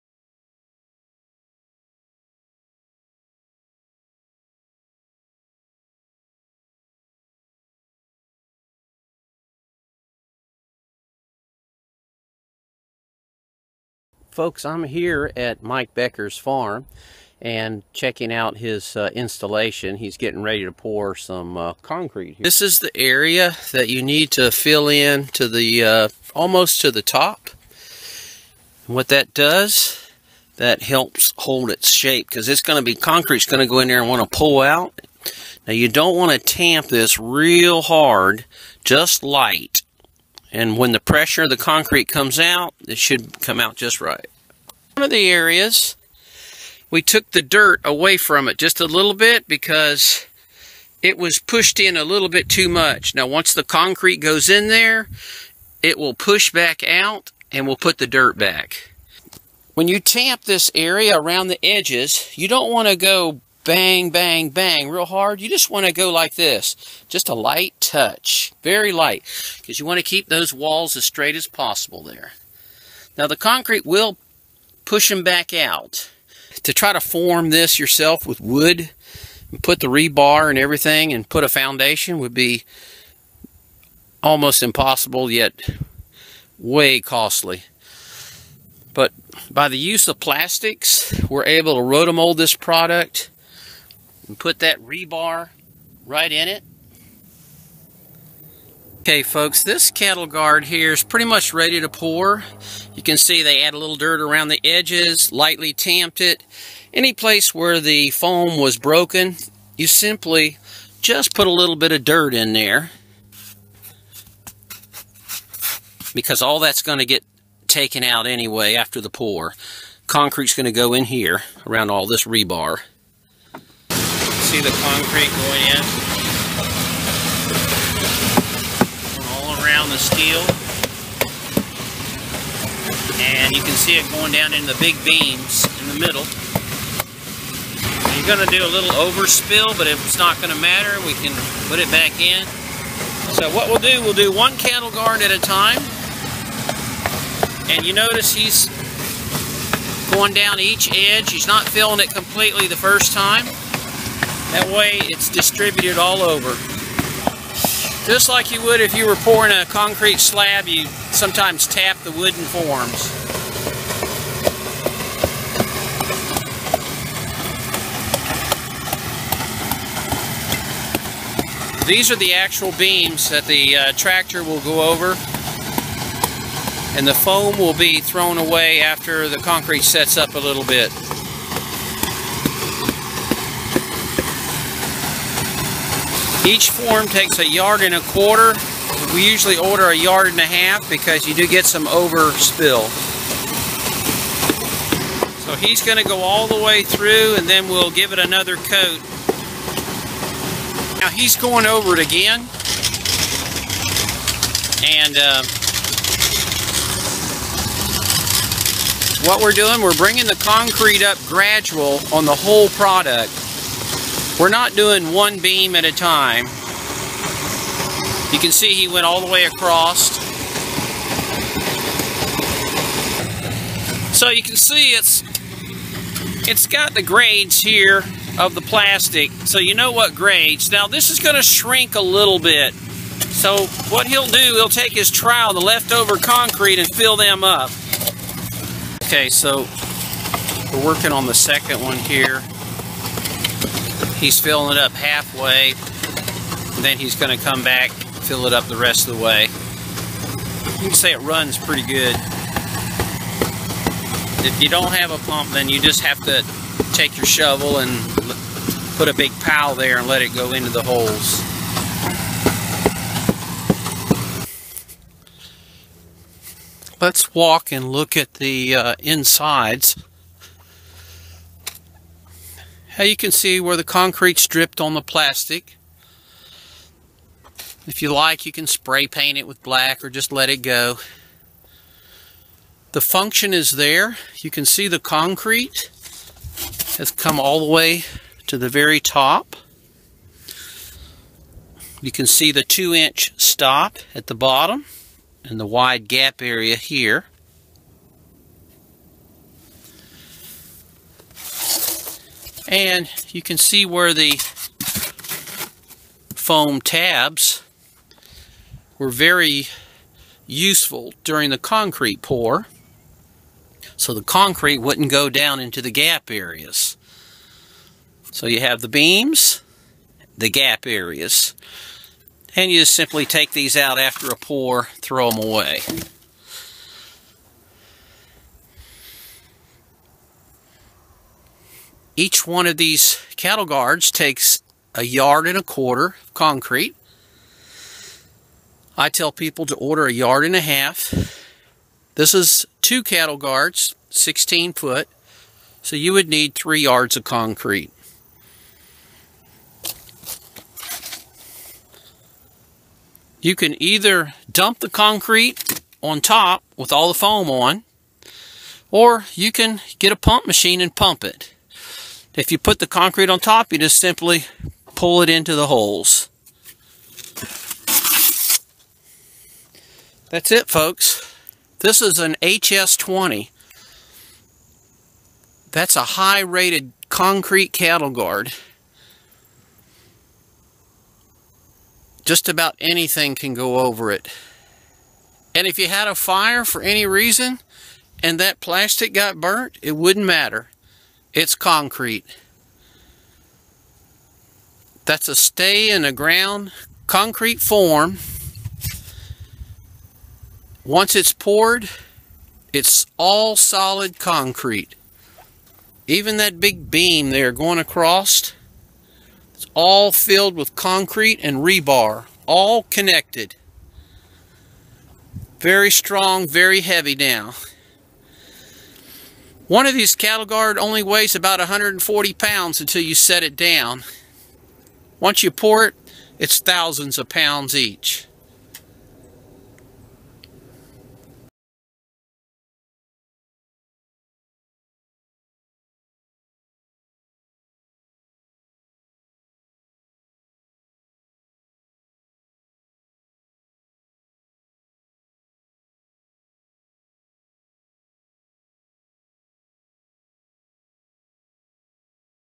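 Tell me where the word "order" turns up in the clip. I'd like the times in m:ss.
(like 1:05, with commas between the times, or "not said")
3:09, 5:39.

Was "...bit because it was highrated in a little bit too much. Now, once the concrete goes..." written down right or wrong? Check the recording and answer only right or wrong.
wrong.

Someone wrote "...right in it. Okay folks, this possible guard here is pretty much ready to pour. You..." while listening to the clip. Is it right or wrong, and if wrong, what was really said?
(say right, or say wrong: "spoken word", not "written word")
wrong: "cattle", not "possible".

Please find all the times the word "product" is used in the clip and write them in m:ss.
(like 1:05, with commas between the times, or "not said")
1:32, 3:32.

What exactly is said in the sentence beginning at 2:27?
And you notice he's going down each edge.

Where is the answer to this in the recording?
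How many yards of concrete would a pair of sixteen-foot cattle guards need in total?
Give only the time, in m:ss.
5:46.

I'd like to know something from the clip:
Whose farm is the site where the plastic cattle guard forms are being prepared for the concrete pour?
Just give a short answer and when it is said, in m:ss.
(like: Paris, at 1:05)
Mike Becker, at 0:15.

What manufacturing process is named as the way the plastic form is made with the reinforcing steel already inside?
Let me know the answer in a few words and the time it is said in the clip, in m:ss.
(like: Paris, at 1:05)
rotomold, at 1:31.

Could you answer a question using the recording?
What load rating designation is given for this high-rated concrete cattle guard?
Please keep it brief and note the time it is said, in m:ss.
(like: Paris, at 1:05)
HS20, at 6:12.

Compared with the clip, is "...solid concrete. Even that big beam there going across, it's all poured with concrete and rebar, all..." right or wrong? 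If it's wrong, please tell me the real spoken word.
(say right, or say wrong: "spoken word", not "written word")
wrong: "filled", not "poured".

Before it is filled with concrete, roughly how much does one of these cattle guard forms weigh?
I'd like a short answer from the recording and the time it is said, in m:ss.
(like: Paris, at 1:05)
140 pounds, at 7:01.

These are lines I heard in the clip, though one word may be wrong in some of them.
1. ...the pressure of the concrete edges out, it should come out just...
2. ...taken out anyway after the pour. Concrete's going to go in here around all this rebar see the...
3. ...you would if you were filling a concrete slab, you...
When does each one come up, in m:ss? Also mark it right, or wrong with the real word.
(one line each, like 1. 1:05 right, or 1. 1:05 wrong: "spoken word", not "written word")
1. 0:40 wrong: "comes", not "edges"
2. 1:57 right
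3. 2:38 wrong: "pouring", not "filling".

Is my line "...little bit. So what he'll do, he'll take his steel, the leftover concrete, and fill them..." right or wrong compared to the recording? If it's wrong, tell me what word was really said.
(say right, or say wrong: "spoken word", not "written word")
wrong: "trowel", not "steel".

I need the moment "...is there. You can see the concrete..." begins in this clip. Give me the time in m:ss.
4:43.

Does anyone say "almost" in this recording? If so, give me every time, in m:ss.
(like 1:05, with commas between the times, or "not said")
0:26, 1:24.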